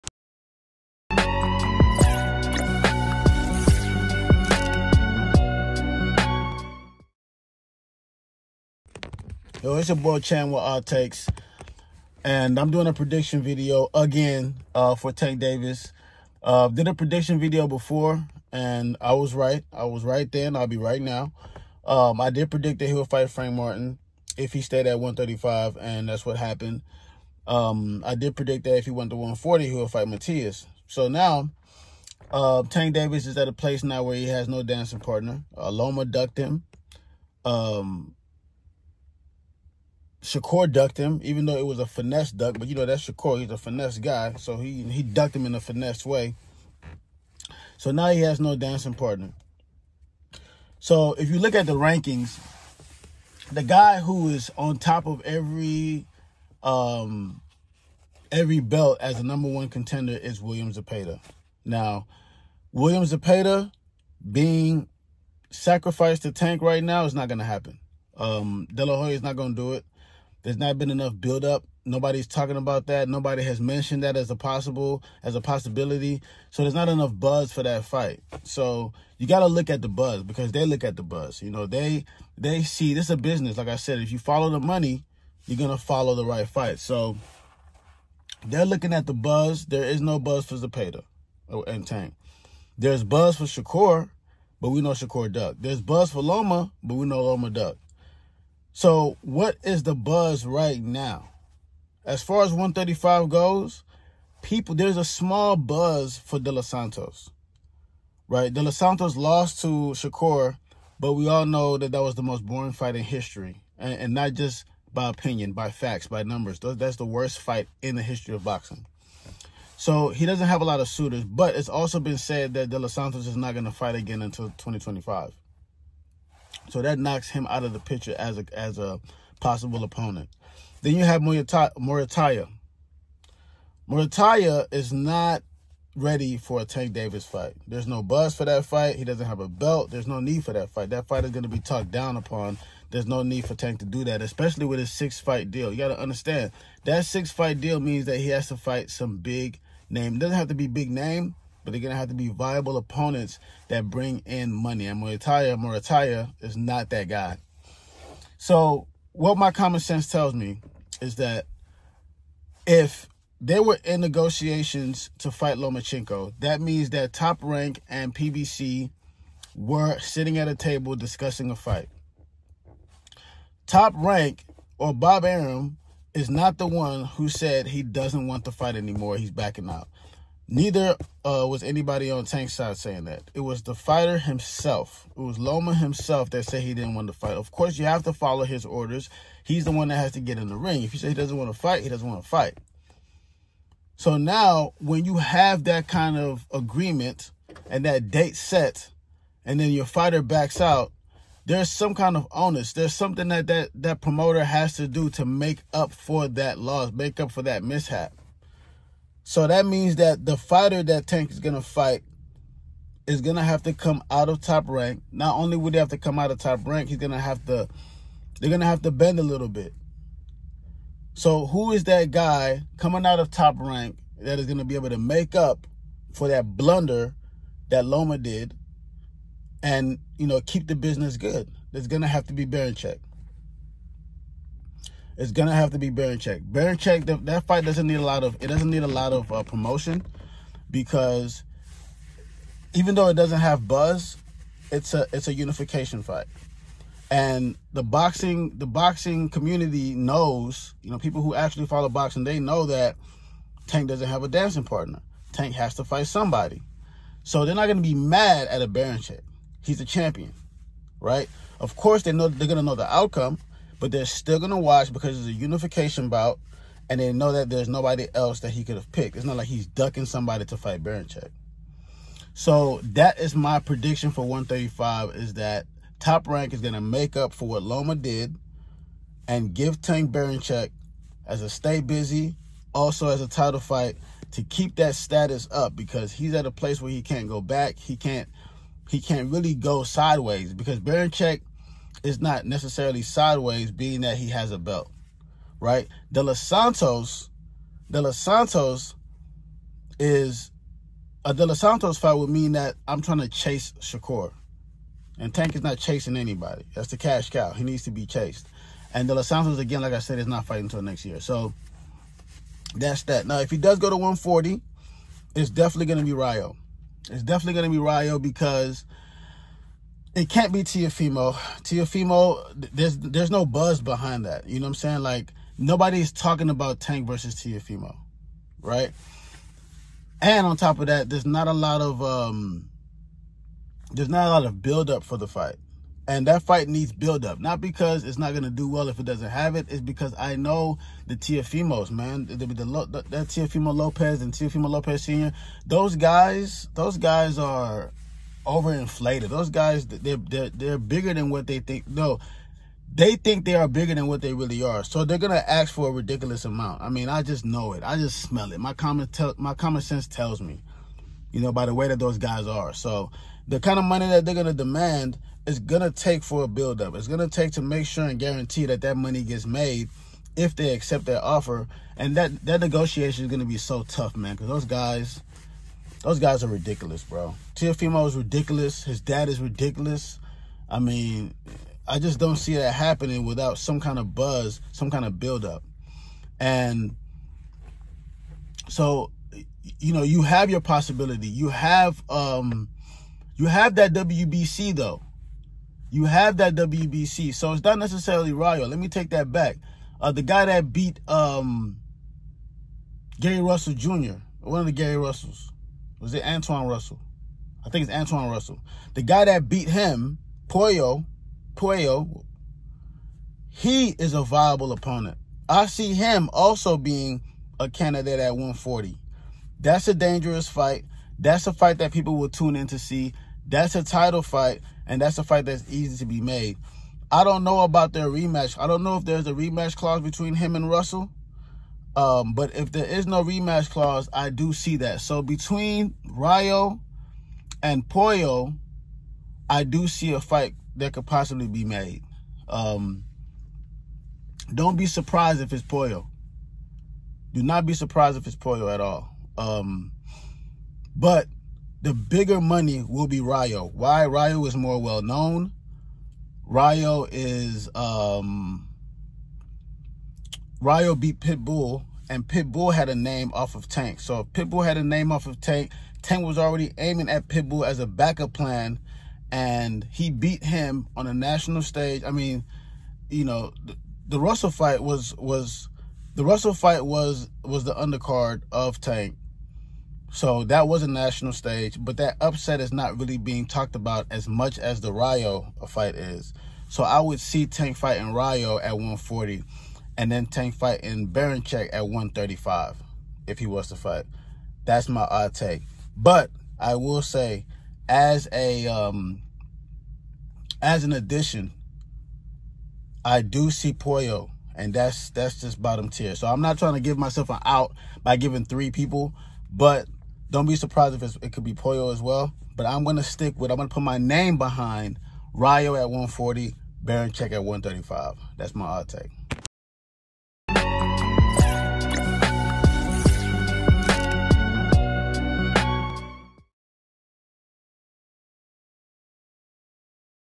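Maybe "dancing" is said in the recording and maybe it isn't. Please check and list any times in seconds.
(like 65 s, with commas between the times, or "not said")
34 s, 48 s, 254 s.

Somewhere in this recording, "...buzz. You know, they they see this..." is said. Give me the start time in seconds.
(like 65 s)
81 s.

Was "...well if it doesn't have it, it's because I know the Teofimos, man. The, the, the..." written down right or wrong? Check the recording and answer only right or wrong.
right.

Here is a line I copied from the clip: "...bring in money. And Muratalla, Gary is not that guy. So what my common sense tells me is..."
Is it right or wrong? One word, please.
wrong.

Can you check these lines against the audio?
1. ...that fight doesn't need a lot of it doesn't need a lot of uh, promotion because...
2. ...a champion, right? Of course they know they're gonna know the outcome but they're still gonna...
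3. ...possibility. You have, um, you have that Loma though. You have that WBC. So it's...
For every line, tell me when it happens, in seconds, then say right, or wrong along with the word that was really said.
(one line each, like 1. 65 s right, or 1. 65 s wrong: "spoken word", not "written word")
1. 237 s right
2. 259 s right
3. 390 s wrong: "WBC", not "Loma".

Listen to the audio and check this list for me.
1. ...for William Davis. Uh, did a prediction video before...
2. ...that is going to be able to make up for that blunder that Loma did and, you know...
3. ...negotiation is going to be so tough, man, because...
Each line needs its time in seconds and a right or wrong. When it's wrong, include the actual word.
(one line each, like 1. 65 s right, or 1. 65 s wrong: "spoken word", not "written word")
1. 14 s wrong: "Tank", not "William"
2. 224 s right
3. 372 s right.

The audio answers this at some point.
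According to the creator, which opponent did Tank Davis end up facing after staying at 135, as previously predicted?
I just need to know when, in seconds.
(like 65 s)
23 s.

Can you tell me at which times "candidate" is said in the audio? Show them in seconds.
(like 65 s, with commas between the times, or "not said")
417 s.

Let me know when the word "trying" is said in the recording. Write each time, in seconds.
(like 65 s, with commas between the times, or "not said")
303 s, 506 s.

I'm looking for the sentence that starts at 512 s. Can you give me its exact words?
But I'm gonna stick with I'm gonna put my name behind Rayo at 140, Berinchyk at 135.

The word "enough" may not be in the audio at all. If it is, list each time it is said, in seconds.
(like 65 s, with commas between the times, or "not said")
70 s, 76 s.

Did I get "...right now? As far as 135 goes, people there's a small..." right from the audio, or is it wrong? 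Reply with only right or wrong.
right.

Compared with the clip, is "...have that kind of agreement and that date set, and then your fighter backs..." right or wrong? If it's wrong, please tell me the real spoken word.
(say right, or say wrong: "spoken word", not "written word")
right.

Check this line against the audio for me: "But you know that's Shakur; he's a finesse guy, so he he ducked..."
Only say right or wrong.
right.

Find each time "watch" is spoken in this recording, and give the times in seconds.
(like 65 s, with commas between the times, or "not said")
264 s.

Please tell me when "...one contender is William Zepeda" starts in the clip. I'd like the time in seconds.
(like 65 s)
59 s.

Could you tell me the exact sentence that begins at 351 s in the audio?
No, they think they are bigger than what they really are.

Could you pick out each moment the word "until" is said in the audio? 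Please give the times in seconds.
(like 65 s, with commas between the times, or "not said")
124 s, 310 s.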